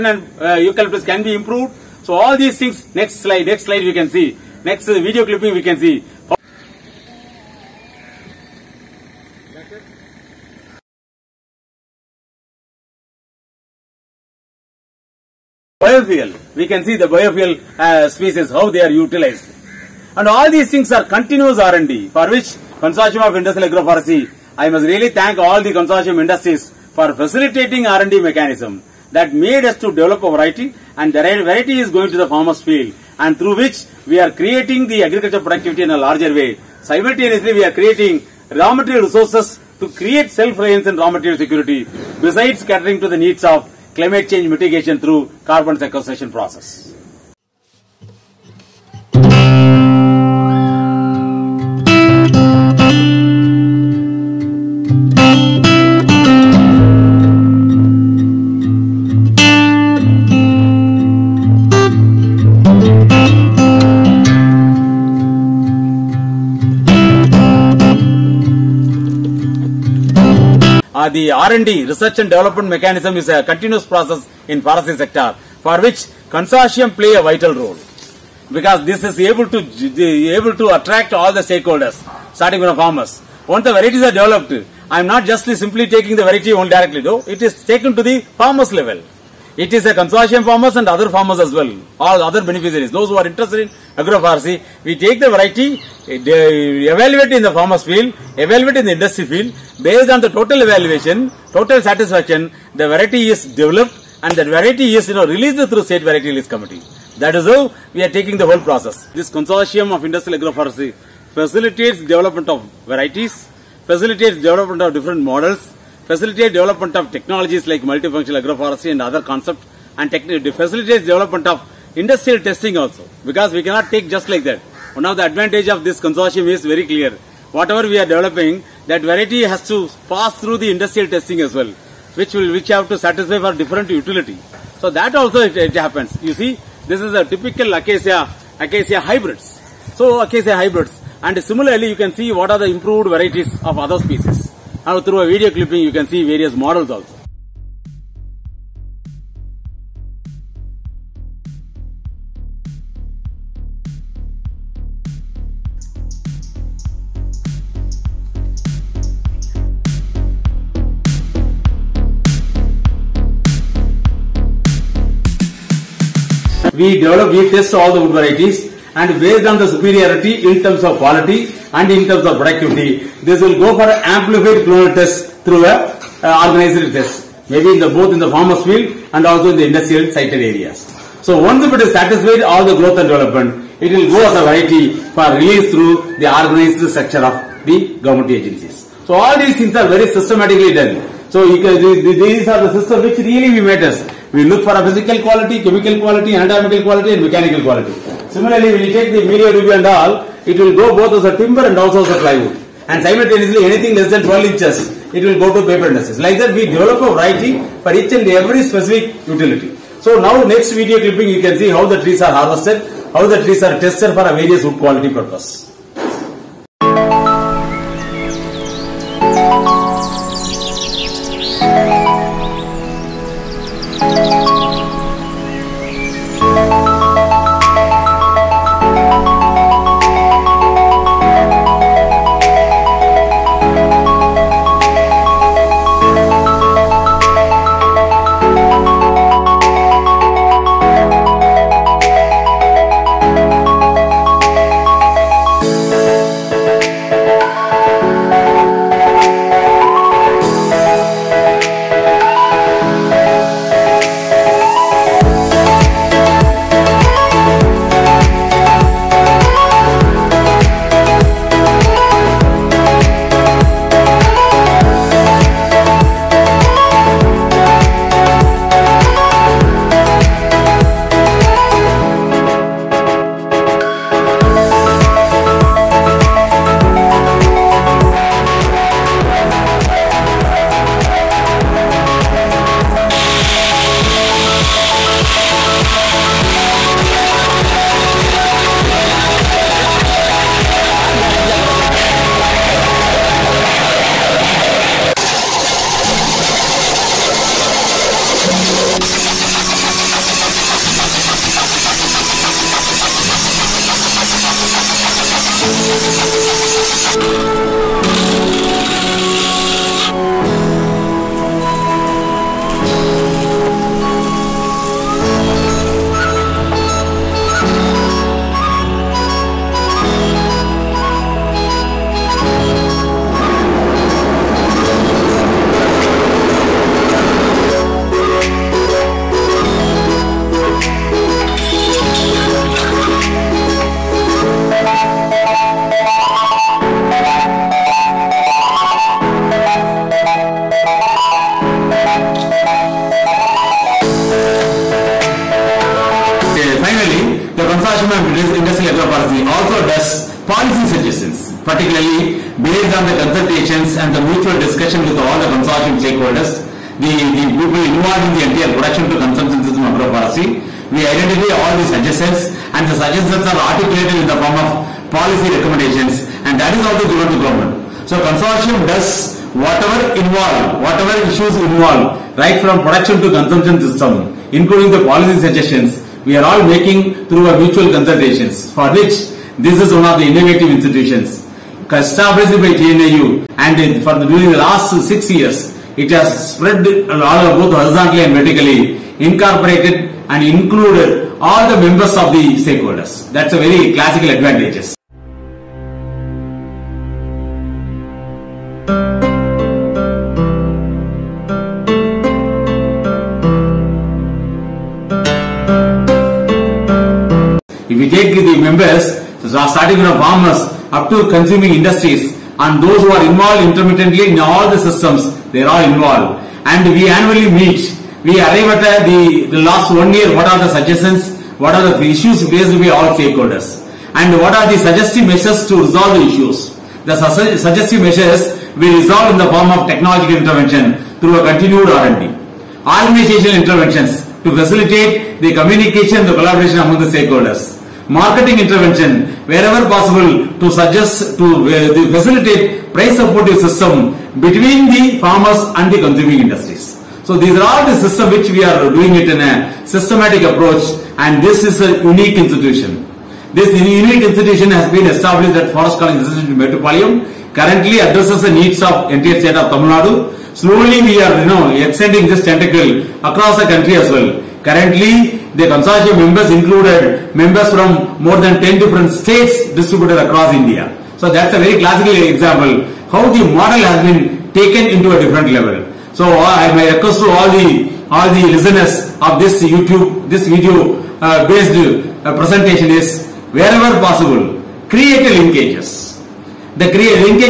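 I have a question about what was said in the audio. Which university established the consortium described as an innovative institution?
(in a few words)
TNAU.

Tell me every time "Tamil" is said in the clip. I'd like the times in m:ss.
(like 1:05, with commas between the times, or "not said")
7:39.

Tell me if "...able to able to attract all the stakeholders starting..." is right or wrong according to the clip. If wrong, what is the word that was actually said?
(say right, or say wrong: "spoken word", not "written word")
right.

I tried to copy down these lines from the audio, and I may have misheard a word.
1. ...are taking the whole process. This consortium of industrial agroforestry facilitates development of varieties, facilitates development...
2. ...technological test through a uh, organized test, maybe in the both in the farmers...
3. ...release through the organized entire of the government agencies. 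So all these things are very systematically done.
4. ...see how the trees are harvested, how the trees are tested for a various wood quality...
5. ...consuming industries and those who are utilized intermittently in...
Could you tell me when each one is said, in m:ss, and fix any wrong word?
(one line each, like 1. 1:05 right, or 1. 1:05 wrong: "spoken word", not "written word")
1. 1:48 right
2. 2:54 wrong: "clonal", not "technological"
3. 3:05 wrong: "structure", not "entire"
4. 3:31 right
5. 6:51 wrong: "involved", not "utilized".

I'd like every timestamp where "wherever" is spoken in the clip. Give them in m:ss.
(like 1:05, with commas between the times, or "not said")
7:19, 8:03.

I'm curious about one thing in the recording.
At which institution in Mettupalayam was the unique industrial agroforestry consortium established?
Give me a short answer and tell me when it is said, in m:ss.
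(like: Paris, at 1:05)
Forest College Institute, at 7:35.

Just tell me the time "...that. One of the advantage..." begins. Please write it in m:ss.
2:04.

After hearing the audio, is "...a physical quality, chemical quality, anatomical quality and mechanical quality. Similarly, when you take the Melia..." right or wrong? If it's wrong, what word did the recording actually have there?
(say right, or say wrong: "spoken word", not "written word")
right.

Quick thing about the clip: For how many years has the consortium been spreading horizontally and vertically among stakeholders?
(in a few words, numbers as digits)
6.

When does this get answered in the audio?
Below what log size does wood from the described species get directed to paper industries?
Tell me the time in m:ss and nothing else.
3:24.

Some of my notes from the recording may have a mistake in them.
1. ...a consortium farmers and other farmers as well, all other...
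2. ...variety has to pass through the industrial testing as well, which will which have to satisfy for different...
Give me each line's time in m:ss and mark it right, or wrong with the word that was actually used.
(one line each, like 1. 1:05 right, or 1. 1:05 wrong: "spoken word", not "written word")
1. 1:29 right
2. 2:09 right.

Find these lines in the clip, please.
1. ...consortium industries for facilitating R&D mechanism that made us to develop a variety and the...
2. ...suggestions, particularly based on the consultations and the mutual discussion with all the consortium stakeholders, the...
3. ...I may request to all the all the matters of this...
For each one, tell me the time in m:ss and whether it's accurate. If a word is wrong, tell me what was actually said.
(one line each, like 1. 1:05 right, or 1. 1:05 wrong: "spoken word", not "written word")
1. 0:25 right
2. 5:50 right
3. 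7:56 wrong: "listeners", not "matters".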